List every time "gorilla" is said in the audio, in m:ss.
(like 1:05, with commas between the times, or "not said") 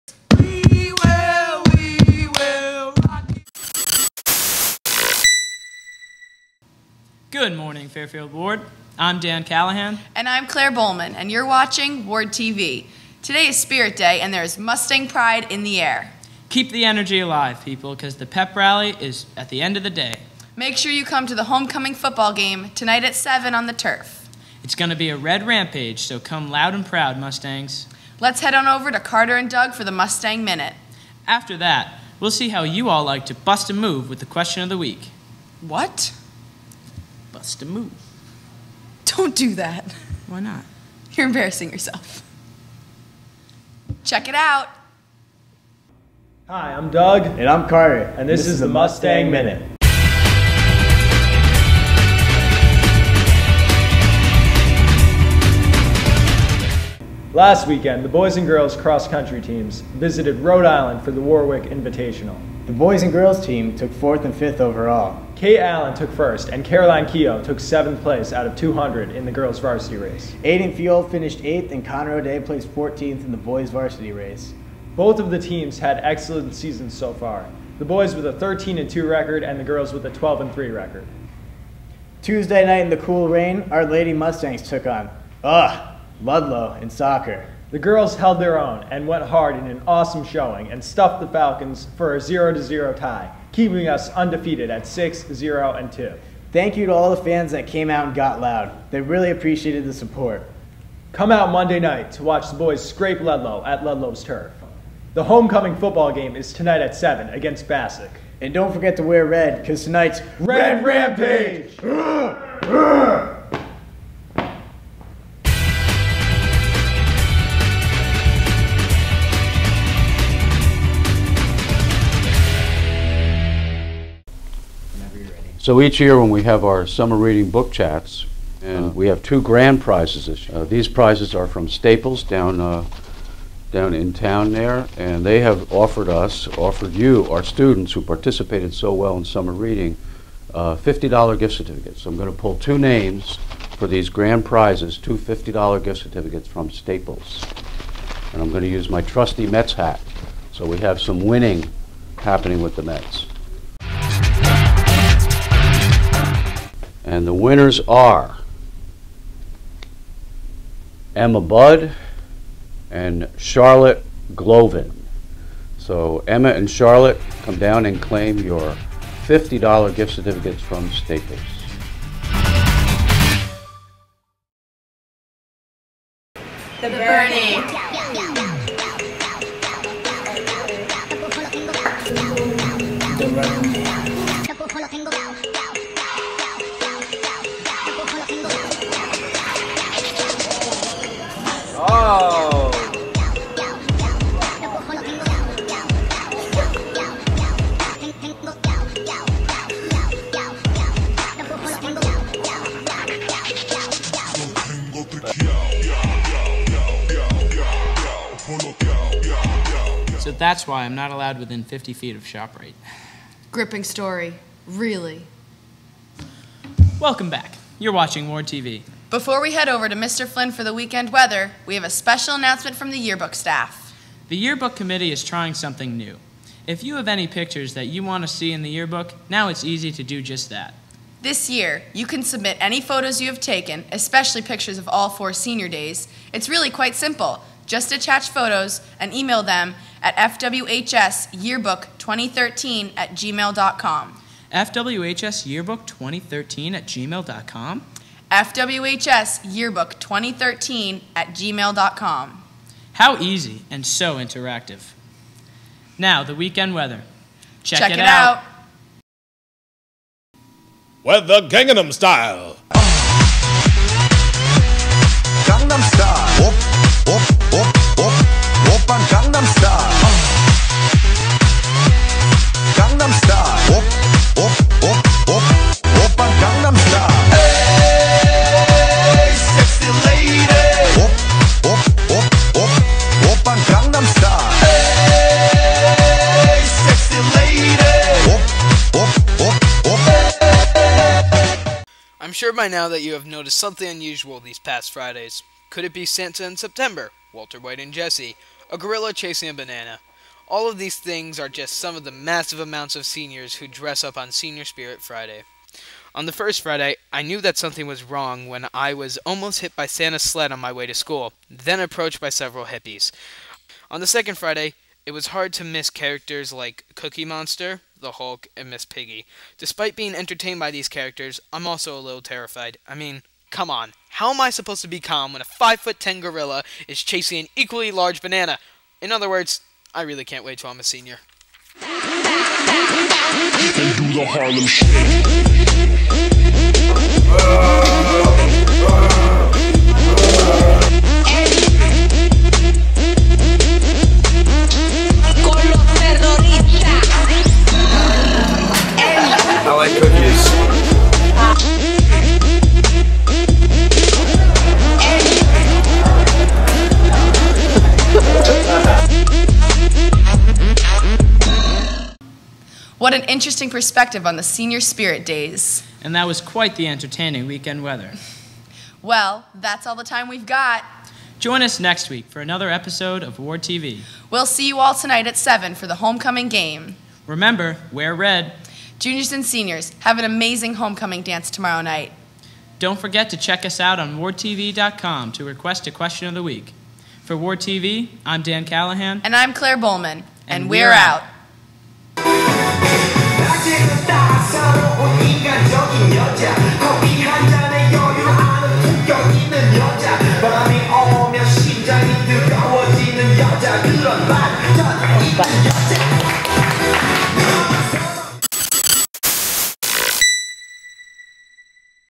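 4:58, 5:26.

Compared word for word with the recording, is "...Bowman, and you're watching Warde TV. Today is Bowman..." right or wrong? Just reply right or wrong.
wrong.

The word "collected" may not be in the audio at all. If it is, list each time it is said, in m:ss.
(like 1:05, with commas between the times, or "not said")
not said.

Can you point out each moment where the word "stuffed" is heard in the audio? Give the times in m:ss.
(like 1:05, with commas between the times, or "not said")
1:30.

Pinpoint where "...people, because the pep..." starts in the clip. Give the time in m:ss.
0:17.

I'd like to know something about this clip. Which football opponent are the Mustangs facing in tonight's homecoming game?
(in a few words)
Bassick.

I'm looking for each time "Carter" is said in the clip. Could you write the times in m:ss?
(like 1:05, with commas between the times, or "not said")
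0:28, 0:47.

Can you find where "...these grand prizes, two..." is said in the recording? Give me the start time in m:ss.
2:23.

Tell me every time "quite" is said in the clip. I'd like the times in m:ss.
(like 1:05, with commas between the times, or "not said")
3:56, 6:06.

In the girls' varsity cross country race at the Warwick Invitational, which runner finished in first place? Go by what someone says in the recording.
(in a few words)
Kay Allen.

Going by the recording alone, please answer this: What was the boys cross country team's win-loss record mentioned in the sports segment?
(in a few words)
13 and 2.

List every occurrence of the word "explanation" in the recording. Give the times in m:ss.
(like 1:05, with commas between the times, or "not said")
not said.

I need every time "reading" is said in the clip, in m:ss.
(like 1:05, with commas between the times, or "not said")
2:07, 2:19.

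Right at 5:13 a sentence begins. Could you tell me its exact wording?
On the second Friday, it was hard to miss characters like Cookie Monster, the Hulk, and Miss Piggy.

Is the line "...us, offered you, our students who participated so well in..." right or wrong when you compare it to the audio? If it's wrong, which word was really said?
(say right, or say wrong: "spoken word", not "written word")
right.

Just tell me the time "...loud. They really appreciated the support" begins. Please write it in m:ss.
1:38.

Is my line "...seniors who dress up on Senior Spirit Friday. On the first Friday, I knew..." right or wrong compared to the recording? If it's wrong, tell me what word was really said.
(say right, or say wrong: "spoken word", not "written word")
right.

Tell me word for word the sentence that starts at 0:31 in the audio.
After that, we'll see how you all like to bust a move with the question of the week.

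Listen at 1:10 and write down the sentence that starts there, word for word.
Aiden Fuel finished eighth, and Connor O'Day placed 14th in the boys' varsity race.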